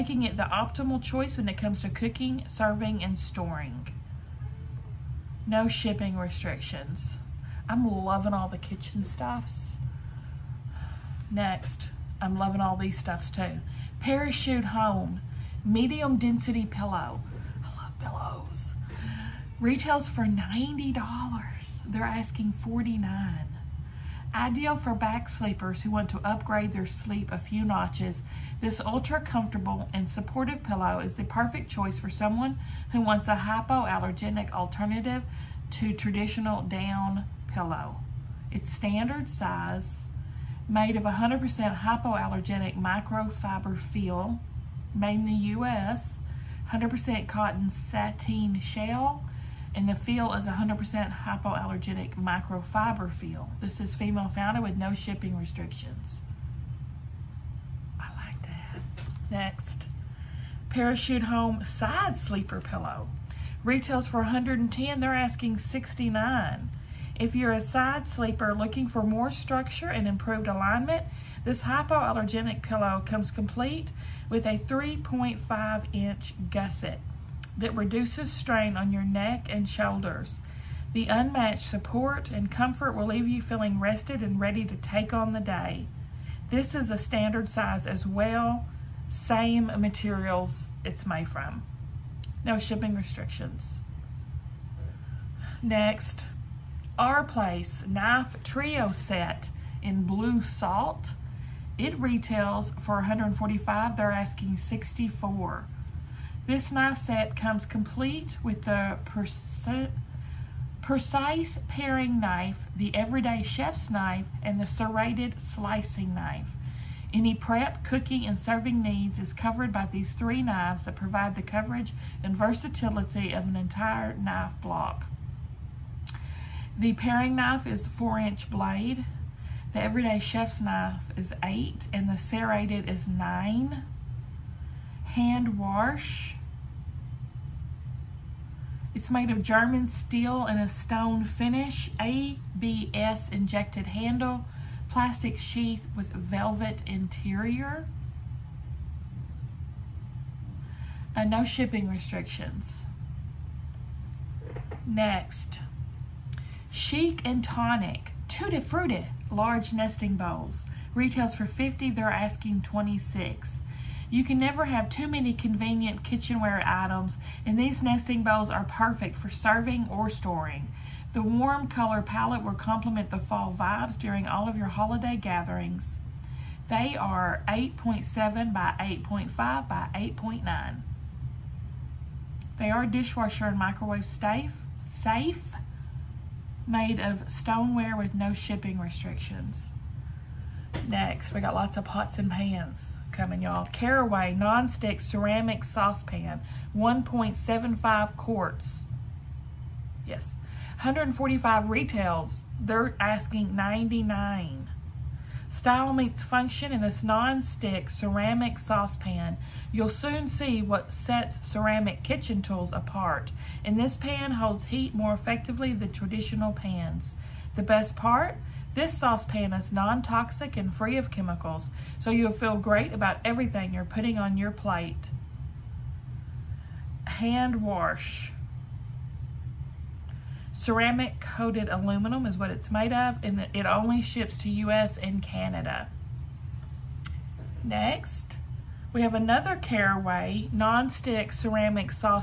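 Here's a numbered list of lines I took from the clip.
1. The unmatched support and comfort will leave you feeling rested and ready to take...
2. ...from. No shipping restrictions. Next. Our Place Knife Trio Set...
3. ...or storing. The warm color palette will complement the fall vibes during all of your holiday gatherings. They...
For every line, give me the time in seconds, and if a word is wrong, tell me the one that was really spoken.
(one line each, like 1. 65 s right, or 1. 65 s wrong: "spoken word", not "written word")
1. 80 s right
2. 91 s right
3. 169 s right.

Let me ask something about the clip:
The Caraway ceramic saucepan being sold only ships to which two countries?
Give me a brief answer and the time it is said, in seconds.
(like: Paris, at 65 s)
US and Canada, at 234 s.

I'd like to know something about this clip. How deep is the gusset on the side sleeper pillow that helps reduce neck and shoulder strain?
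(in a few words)
3.5 inch.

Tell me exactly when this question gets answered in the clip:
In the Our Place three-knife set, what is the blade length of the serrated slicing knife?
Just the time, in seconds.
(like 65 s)
133 s.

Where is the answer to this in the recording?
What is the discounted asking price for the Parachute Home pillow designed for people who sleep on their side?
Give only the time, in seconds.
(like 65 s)
65 s.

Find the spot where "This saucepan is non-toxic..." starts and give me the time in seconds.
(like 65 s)
218 s.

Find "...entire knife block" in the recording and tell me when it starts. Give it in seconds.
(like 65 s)
123 s.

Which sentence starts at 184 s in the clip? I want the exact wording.
Safe made of stoneware with no shipping restrictions.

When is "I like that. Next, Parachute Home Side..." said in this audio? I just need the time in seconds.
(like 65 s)
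58 s.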